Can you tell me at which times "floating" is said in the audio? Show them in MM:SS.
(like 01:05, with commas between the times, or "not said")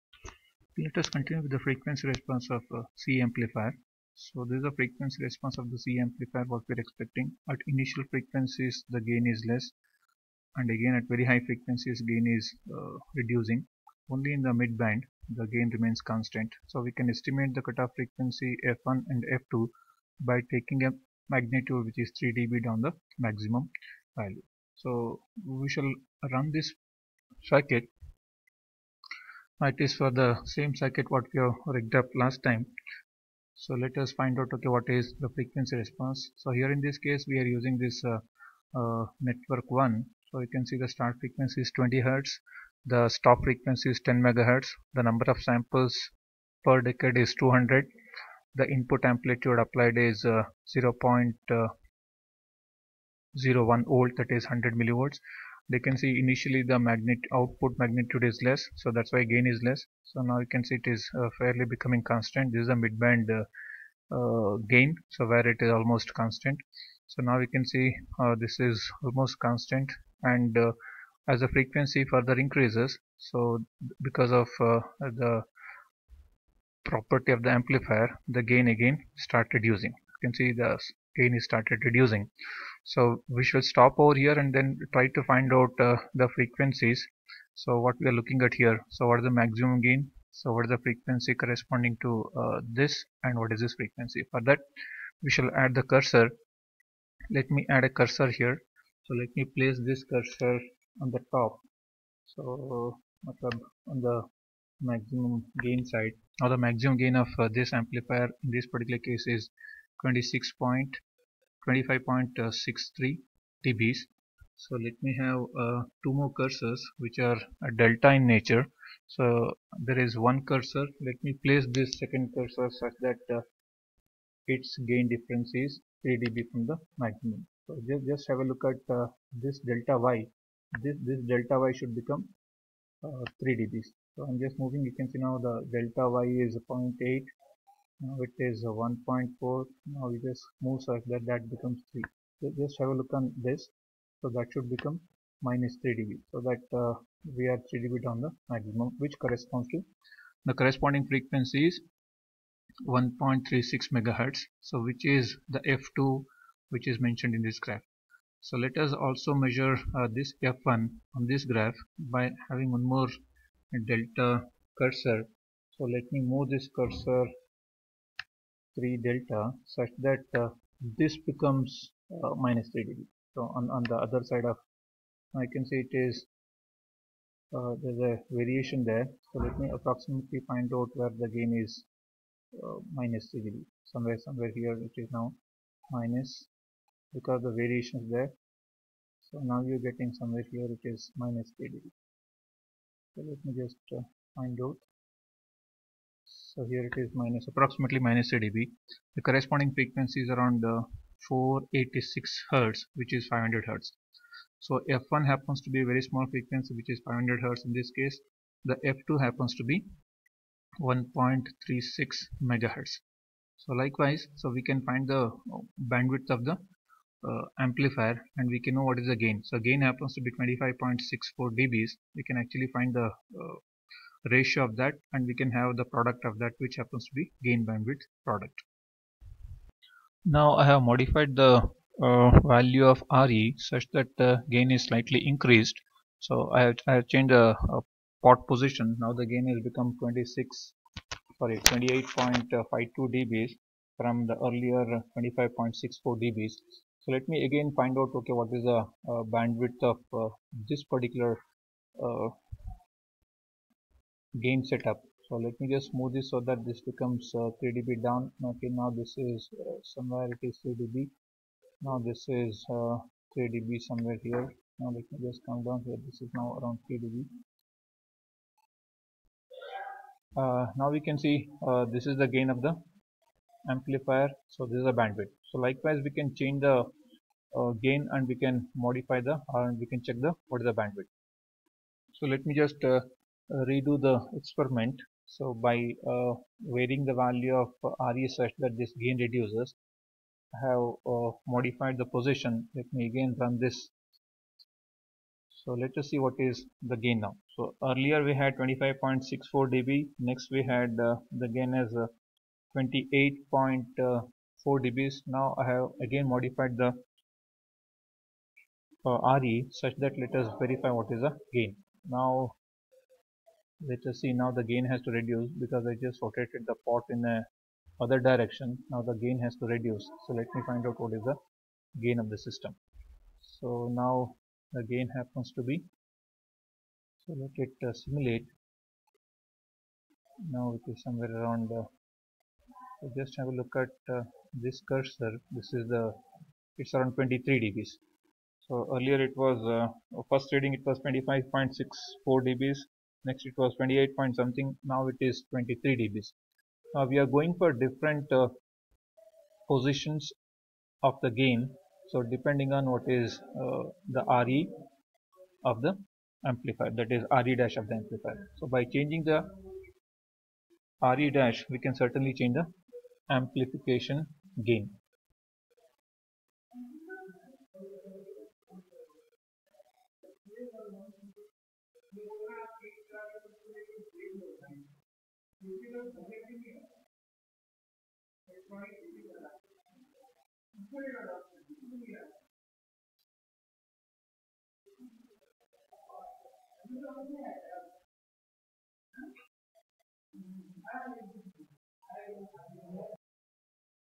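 not said.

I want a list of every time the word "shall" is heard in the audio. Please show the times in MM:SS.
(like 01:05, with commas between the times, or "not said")
00:25, 01:35.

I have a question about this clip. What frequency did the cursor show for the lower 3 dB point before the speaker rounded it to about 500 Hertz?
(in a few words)
486 Hertz.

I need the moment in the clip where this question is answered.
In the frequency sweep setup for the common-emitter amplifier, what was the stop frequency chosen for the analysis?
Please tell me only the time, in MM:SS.
00:44.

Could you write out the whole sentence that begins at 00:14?
Only in the mid band the gain remains constant.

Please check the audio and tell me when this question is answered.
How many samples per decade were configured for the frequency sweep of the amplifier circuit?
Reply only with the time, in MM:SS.
00:47.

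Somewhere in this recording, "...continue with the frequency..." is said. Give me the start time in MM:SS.
00:01.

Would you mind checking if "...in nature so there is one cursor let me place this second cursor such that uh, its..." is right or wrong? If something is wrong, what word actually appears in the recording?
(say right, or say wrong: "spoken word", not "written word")
right.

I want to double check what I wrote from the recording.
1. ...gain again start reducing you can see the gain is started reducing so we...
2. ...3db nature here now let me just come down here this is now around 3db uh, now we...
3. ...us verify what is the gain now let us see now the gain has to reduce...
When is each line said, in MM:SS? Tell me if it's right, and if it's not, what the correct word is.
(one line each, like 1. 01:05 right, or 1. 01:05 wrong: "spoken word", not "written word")
1. 01:18 right
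2. 04:23 wrong: "somewhere", not "nature"
3. 05:10 right.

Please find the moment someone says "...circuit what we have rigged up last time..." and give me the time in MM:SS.
00:30.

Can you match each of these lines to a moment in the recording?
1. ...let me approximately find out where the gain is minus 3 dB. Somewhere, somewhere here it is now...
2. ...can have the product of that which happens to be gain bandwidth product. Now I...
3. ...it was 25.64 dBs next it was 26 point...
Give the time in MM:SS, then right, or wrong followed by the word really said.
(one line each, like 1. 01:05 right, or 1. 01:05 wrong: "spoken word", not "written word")
1. 02:59 right
2. 03:45 right
3. 05:40 wrong: "28", not "26".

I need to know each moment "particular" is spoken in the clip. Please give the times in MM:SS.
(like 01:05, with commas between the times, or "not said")
01:48, 04:10.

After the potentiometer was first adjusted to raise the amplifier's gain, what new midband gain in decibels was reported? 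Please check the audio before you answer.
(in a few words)
28.52 dB.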